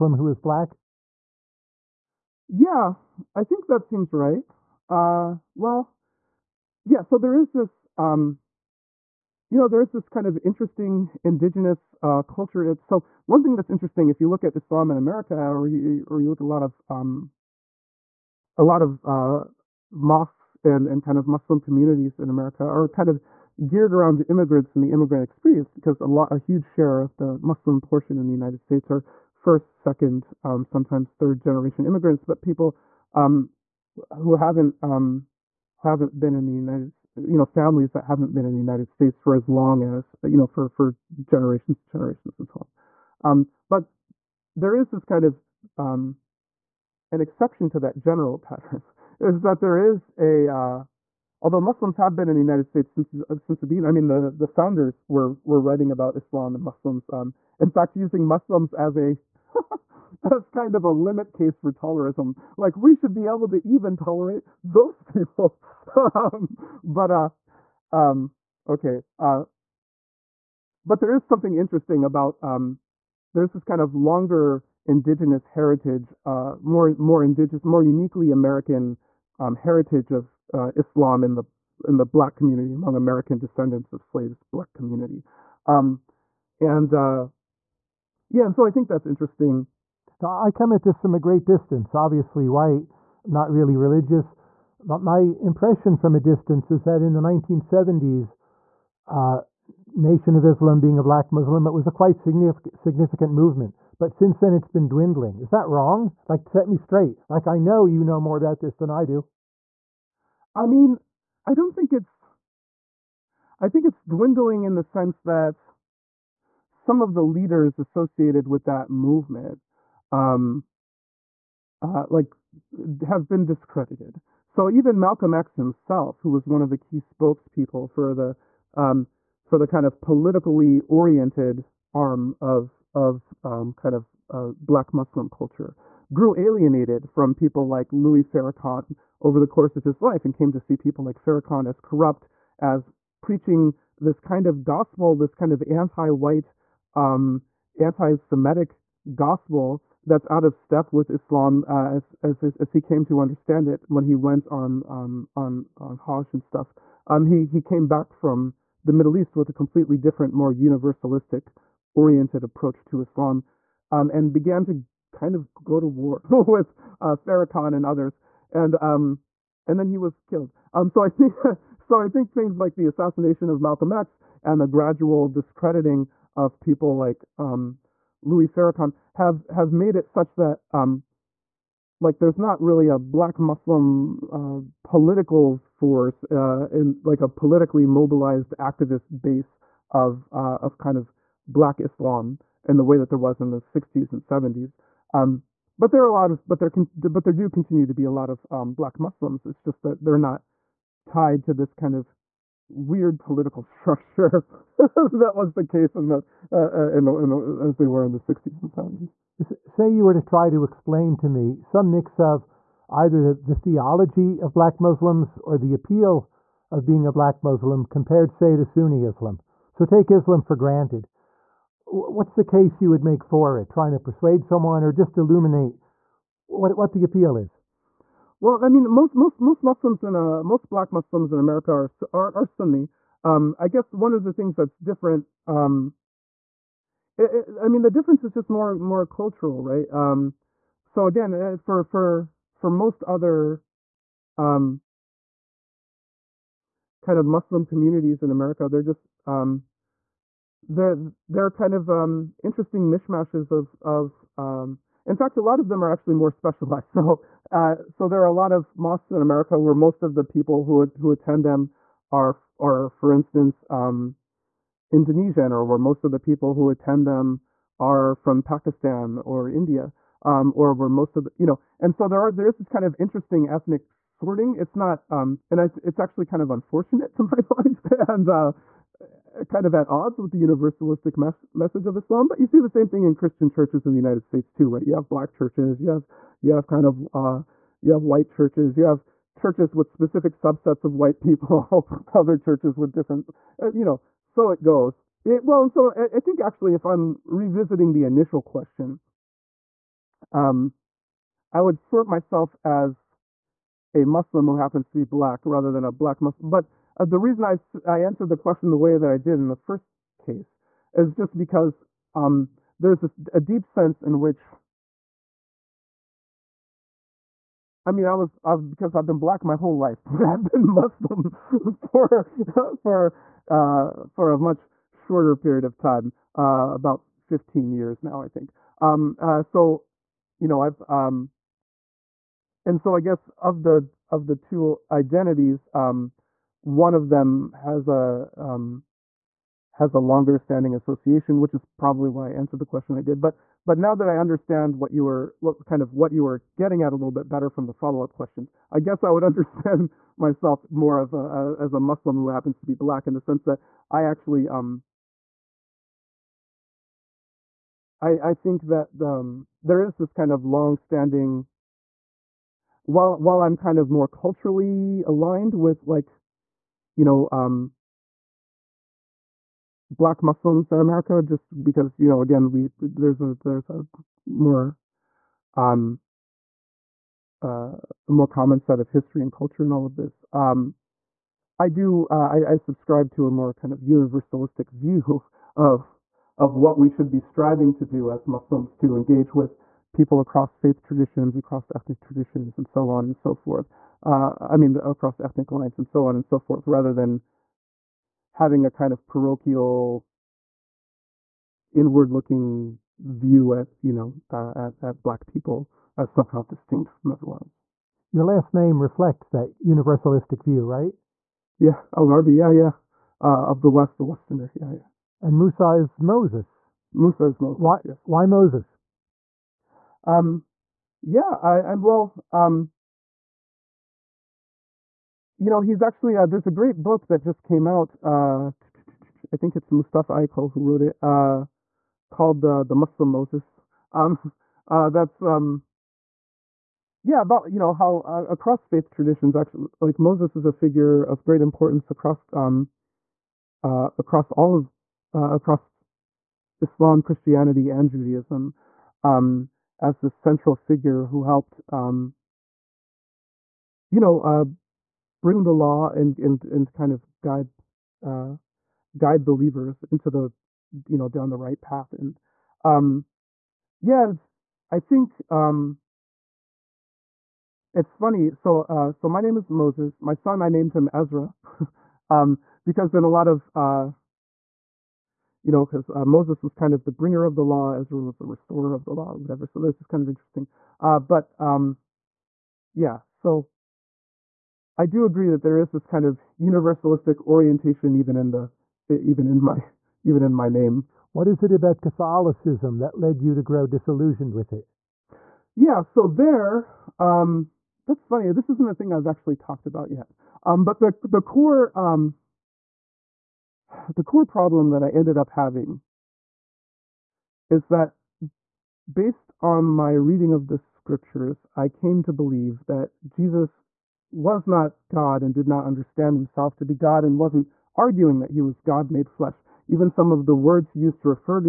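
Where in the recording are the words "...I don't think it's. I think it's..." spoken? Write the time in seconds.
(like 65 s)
111 s.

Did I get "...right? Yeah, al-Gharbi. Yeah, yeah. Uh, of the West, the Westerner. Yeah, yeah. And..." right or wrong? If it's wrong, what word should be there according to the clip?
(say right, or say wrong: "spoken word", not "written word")
right.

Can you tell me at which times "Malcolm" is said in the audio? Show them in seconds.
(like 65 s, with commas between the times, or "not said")
124 s, 173 s.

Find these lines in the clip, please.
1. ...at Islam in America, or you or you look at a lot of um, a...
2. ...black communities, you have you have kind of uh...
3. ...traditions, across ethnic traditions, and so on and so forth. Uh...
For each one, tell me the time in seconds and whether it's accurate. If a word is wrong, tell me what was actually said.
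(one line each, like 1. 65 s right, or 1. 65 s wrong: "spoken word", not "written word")
1. 14 s right
2. 285 s wrong: "churches", not "communities"
3. 390 s right.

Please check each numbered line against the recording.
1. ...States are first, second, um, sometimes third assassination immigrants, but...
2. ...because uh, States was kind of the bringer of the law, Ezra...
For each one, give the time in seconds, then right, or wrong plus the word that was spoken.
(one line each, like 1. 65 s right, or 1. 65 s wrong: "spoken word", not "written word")
1. 28 s wrong: "generation", not "assassination"
2. 475 s wrong: "Moses", not "States".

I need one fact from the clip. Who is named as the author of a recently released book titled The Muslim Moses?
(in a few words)
Mustafa Akyol.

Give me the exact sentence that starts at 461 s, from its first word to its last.
And um, yeah, and I think um, it's funny.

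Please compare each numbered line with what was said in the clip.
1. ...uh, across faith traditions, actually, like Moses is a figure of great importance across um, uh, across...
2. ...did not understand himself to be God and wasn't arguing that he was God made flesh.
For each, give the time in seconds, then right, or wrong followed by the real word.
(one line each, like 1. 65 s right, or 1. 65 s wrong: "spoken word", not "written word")
1. 437 s right
2. 515 s right.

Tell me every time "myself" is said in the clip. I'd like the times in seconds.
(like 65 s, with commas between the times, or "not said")
302 s, 350 s.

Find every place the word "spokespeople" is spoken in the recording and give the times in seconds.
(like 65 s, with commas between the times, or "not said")
126 s.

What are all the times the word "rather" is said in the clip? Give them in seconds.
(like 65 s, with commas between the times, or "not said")
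305 s, 396 s.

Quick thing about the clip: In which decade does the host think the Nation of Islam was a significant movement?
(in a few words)
1970s.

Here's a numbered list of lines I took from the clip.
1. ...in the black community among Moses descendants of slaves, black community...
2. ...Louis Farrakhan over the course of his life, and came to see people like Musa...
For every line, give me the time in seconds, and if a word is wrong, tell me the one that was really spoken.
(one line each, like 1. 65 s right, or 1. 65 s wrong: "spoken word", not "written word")
1. 81 s wrong: "American", not "Moses"
2. 137 s wrong: "Farrakhan", not "Musa".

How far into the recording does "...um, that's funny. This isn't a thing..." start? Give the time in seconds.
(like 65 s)
496 s.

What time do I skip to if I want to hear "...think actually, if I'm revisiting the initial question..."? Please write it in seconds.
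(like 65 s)
296 s.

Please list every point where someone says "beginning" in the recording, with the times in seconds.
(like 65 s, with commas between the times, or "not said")
53 s.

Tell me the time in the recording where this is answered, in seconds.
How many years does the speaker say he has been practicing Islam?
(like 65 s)
326 s.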